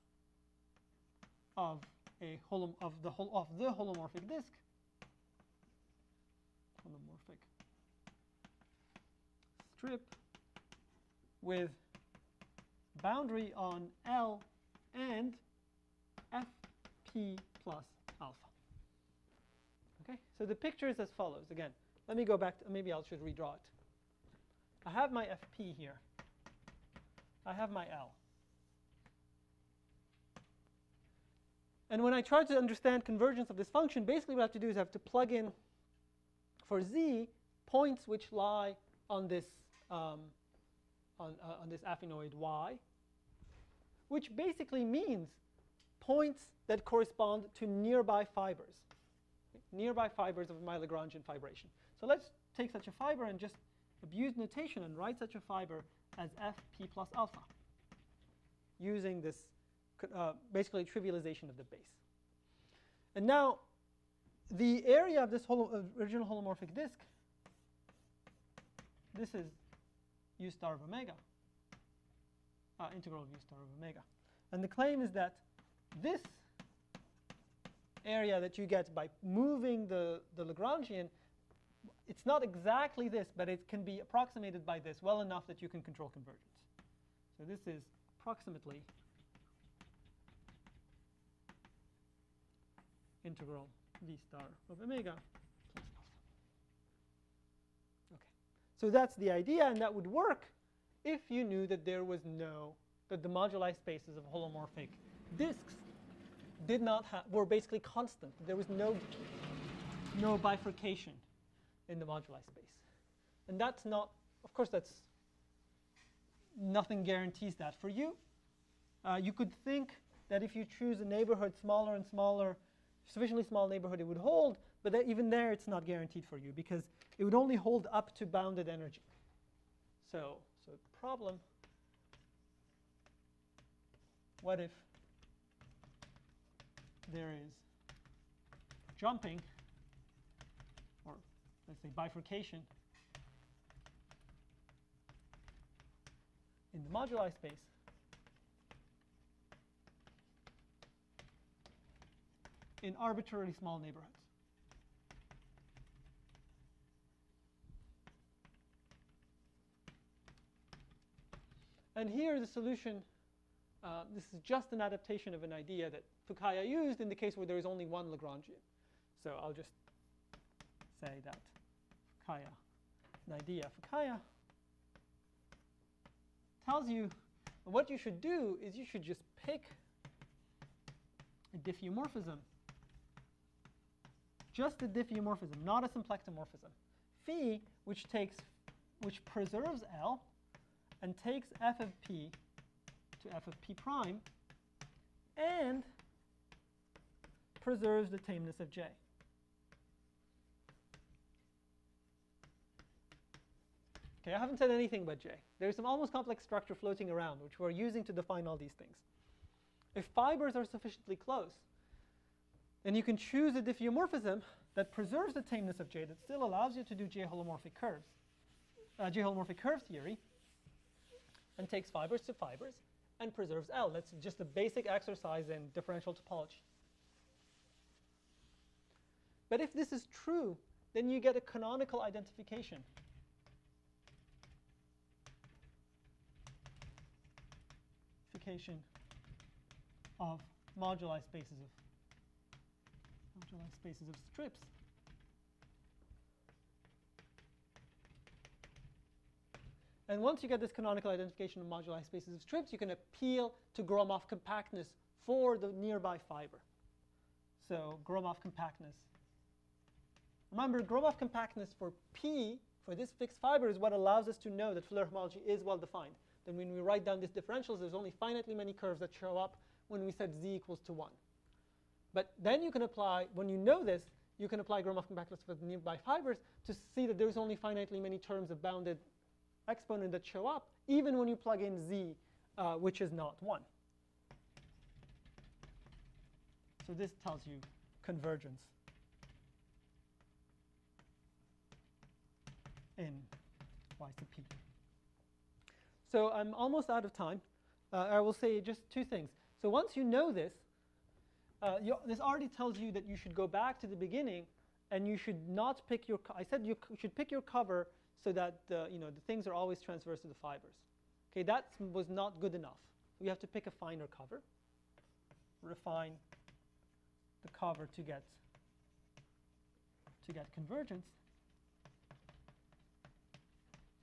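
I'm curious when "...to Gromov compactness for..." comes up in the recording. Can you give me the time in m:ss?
4:13.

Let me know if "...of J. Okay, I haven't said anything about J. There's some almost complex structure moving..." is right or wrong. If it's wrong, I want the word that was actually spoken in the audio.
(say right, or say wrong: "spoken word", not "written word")
wrong: "floating", not "moving".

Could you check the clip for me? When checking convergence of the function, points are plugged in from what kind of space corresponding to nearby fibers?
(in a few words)
affinoid.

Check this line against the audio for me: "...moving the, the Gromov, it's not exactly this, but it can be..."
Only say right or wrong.
wrong.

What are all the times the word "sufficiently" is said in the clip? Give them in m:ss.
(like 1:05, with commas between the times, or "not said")
2:03, 3:30.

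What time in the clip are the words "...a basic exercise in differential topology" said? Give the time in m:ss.
3:44.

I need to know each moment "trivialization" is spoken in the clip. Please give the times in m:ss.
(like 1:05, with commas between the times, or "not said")
1:00.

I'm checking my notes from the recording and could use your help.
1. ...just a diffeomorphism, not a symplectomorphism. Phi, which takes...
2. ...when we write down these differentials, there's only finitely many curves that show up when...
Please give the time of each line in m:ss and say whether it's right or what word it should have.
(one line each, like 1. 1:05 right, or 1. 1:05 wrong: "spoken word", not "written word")
1. 3:04 right
2. 4:26 right.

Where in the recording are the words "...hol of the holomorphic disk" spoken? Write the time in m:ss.
0:03.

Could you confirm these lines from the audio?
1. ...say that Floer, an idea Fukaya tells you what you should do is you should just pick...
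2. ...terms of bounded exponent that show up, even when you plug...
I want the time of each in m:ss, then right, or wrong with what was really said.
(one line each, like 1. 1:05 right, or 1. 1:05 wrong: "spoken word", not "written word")
1. 2:51 wrong: "Fukaya", not "Floer"
2. 4:38 right.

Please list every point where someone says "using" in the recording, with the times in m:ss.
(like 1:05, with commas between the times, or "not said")
0:58, 3:27.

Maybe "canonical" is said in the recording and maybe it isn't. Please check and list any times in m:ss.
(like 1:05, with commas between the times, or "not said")
3:51, 4:10.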